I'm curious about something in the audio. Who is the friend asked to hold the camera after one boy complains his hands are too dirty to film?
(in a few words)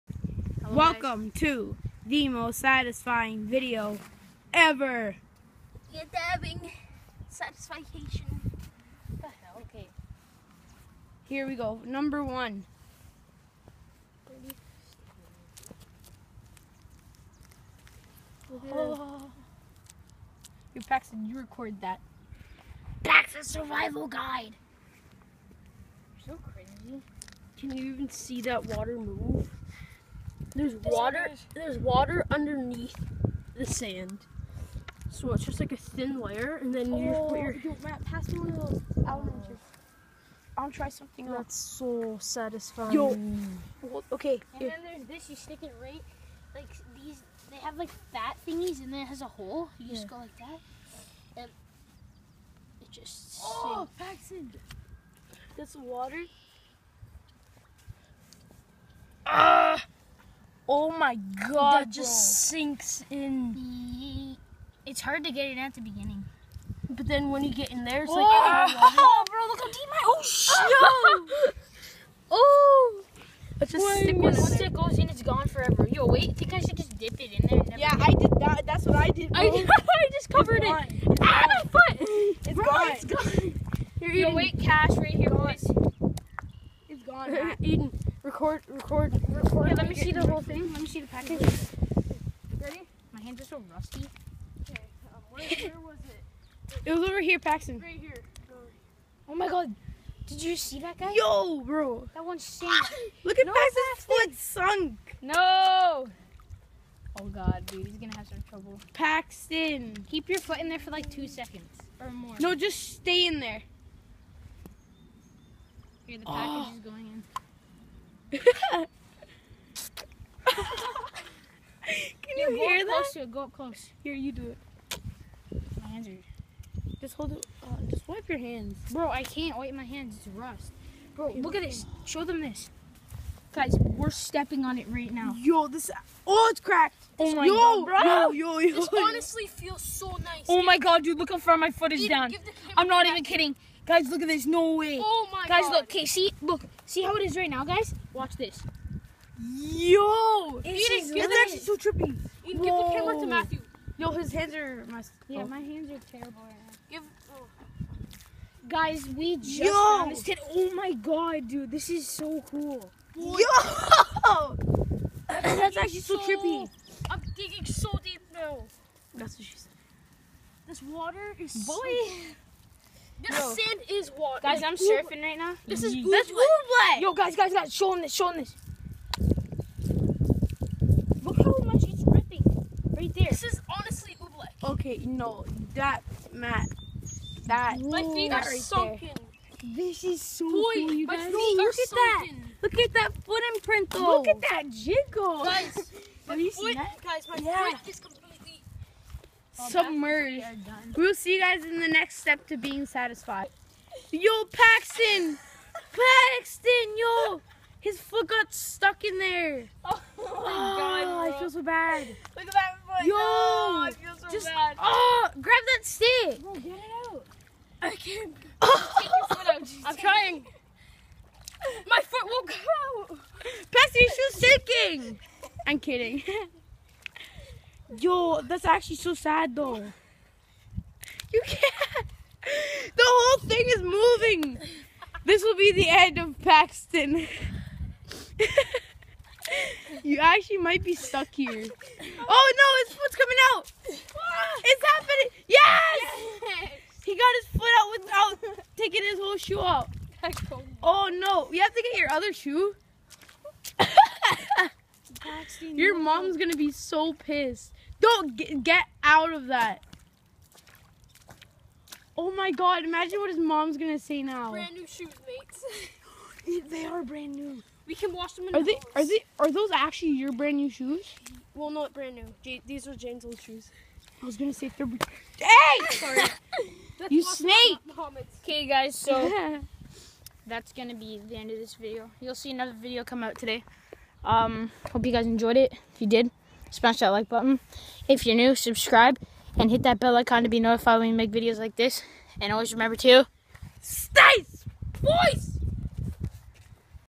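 Matthew.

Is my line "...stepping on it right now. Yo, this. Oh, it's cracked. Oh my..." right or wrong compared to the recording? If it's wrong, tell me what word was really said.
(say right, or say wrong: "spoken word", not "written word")
right.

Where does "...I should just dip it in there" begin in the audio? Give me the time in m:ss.
1:16.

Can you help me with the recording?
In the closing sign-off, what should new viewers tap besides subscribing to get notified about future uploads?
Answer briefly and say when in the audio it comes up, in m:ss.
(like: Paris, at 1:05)
Bell icon, at 4:49.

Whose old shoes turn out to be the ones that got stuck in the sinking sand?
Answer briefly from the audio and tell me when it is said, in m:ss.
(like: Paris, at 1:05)
Jane, at 4:32.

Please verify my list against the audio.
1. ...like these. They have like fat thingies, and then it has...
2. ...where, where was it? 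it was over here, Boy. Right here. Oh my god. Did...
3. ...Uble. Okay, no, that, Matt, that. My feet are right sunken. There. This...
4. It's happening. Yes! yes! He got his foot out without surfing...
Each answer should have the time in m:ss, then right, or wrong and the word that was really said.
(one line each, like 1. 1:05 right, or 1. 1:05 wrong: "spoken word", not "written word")
1. 0:46 right
2. 1:35 wrong: "Paxton", not "Boy"
3. 3:04 right
4. 4:03 wrong: "taking", not "surfing".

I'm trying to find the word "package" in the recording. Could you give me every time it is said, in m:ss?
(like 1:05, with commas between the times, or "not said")
1:31, 1:56.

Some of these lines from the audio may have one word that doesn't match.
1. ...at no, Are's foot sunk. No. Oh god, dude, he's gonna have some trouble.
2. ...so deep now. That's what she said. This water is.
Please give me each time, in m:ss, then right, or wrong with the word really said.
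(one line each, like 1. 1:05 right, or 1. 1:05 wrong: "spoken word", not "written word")
1. 1:43 wrong: "Paxton", not "Are"
2. 2:47 right.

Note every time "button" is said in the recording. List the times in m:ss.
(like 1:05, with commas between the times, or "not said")
4:47.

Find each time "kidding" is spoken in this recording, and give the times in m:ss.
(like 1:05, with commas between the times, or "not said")
2:23, 3:45.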